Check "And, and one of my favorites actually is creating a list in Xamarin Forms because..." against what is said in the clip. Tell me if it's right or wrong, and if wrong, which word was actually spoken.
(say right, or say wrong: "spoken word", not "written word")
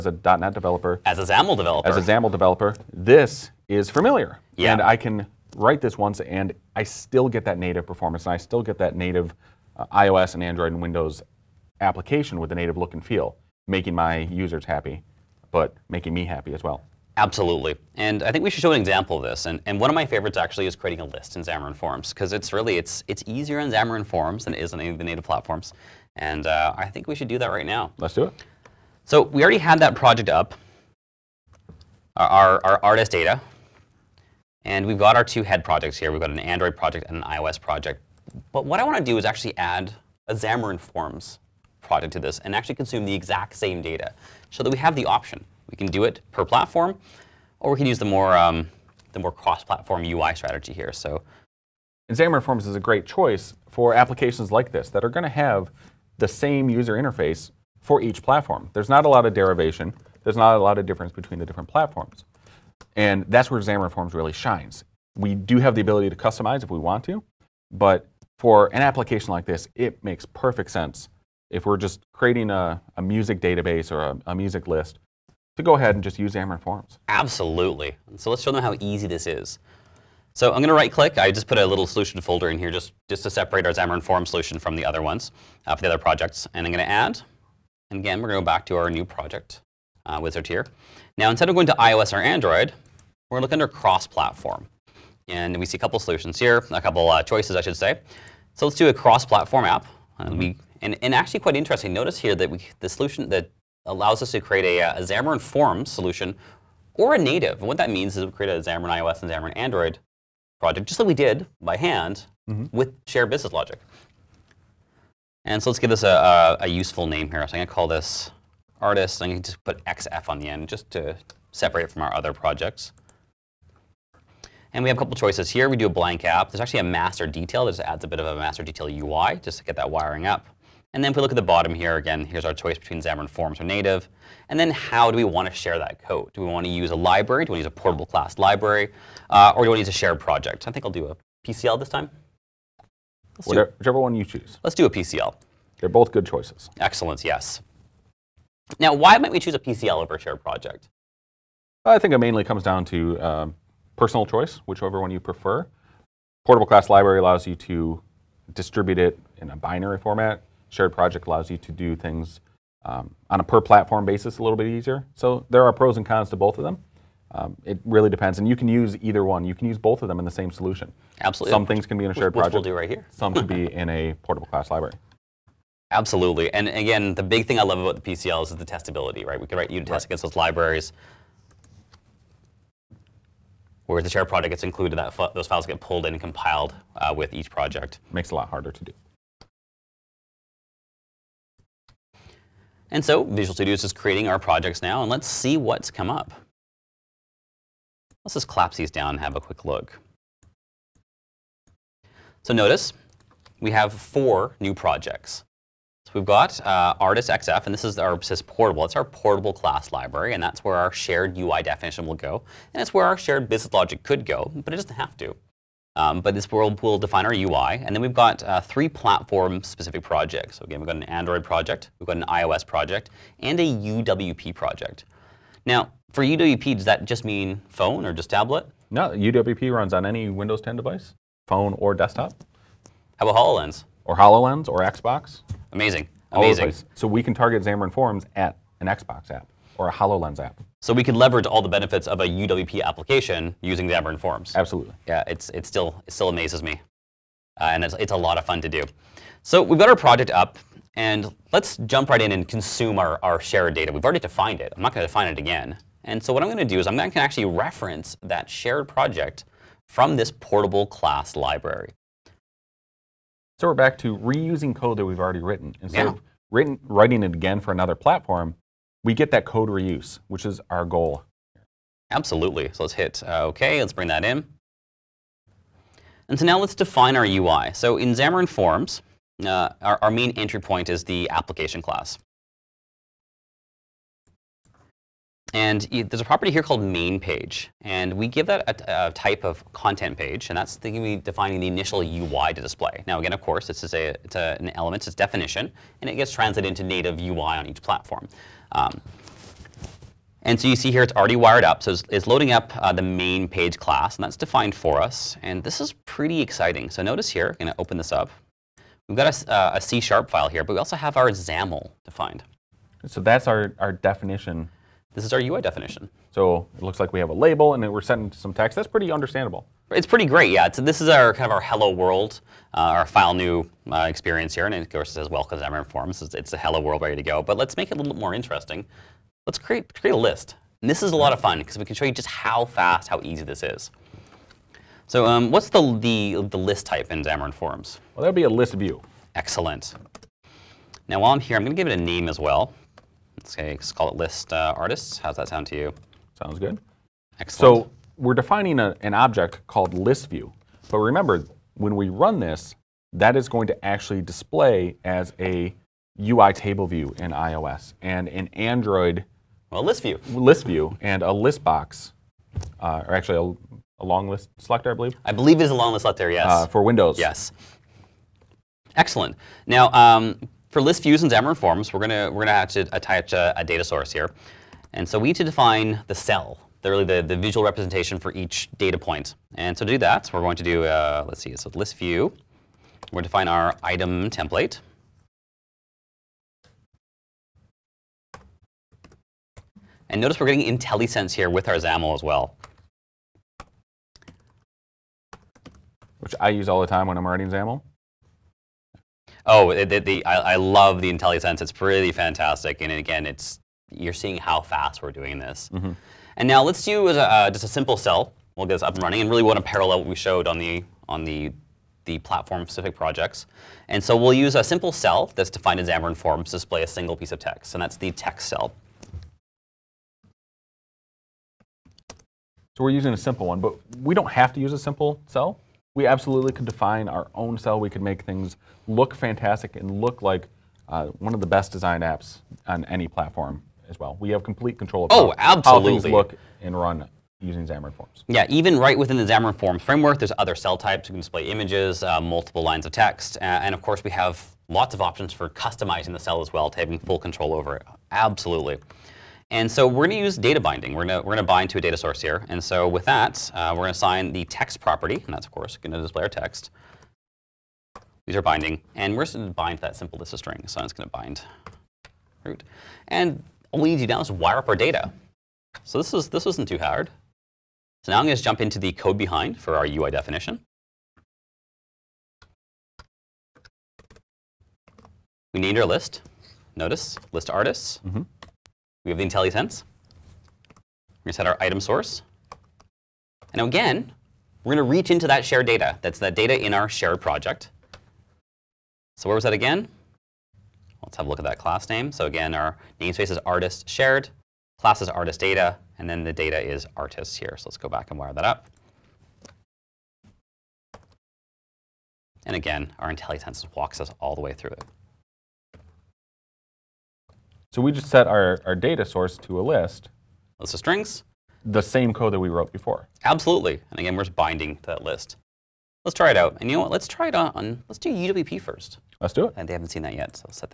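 right.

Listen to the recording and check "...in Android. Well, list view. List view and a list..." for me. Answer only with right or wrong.
right.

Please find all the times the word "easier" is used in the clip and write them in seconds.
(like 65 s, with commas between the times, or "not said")
23 s, 164 s.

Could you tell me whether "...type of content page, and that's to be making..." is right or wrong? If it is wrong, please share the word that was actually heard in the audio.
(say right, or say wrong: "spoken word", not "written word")
wrong: "defining", not "making".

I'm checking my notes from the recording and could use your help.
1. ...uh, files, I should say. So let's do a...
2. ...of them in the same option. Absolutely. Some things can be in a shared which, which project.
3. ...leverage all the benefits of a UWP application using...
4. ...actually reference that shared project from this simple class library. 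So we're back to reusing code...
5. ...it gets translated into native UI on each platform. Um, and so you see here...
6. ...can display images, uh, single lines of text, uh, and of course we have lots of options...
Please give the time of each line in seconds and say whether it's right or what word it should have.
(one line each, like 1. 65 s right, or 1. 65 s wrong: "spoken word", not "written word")
1. 97 s wrong: "choices", not "files"
2. 170 s wrong: "solution", not "option"
3. 241 s right
4. 257 s wrong: "portable", not "simple"
5. 296 s right
6. 441 s wrong: "multiple", not "single".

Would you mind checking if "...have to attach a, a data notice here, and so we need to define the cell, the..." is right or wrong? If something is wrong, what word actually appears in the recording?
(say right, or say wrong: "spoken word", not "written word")
wrong: "source", not "notice".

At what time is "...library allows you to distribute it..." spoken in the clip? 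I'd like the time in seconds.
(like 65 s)
156 s.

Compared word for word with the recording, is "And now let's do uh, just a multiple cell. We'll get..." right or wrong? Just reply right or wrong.
wrong.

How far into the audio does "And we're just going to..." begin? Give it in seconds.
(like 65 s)
458 s.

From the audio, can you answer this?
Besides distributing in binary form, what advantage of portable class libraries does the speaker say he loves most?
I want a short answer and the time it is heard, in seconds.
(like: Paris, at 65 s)
testability, at 178 s.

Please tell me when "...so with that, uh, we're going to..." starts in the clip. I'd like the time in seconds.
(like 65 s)
452 s.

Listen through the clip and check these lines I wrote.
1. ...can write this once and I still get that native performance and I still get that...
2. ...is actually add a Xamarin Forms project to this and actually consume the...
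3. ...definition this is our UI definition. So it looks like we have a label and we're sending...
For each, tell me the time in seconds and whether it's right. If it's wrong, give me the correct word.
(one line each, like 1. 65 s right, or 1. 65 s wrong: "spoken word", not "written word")
1. 4 s right
2. 39 s right
3. 313 s right.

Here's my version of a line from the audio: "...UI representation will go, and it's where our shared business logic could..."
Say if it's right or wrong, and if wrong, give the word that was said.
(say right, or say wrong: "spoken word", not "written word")
wrong: "definition", not "representation".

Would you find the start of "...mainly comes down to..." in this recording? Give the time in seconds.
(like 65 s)
152 s.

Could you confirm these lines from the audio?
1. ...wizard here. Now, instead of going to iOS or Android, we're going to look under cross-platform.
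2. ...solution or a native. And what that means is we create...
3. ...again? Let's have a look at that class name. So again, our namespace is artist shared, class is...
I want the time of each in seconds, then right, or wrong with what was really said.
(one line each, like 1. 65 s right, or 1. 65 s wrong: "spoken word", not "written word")
1. 90 s right
2. 105 s right
3. 489 s right.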